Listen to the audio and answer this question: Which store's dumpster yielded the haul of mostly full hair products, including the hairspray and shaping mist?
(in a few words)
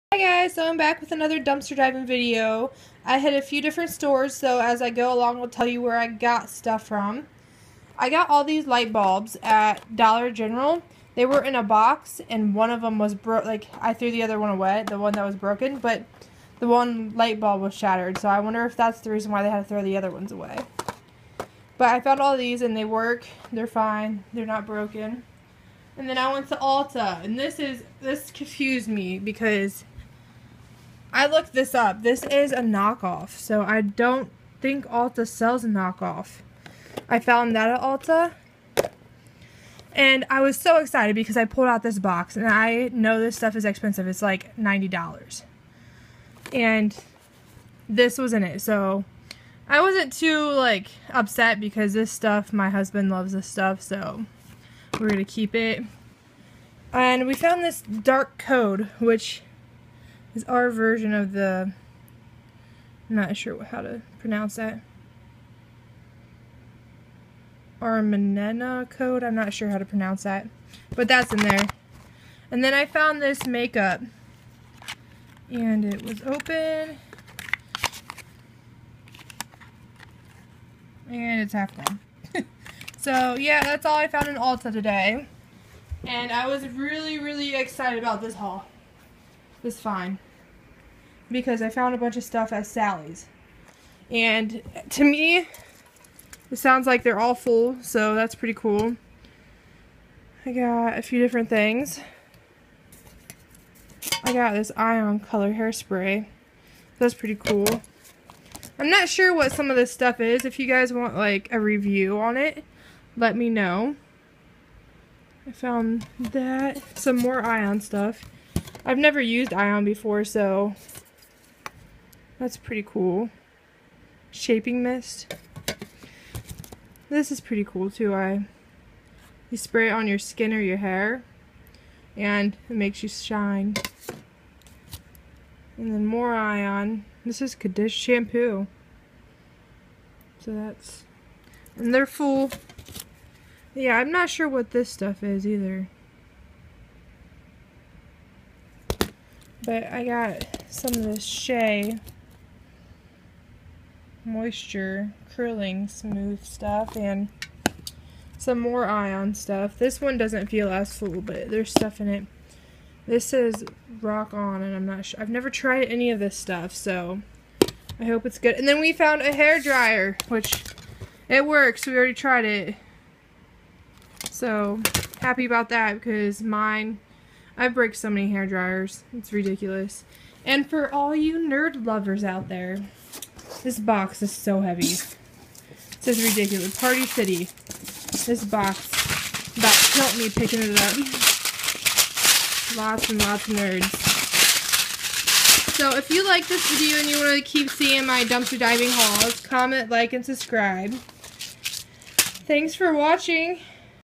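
Sally's.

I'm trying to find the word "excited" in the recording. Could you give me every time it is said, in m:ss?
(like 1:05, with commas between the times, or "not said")
0:40, 1:27.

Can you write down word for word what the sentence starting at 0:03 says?
I hit a few different stores, so as I go along, I'll tell you where I got stuff from.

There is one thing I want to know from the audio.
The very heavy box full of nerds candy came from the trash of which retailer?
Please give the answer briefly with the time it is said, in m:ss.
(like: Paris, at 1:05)
Party City, at 3:06.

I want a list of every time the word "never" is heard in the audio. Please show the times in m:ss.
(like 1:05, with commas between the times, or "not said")
1:58, 2:45.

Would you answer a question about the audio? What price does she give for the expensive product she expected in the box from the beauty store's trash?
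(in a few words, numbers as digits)
$90.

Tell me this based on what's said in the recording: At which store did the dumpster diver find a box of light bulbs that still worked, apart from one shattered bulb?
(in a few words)
Dollar General.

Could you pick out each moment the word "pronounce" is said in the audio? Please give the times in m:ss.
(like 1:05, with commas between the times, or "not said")
1:04, 1:09.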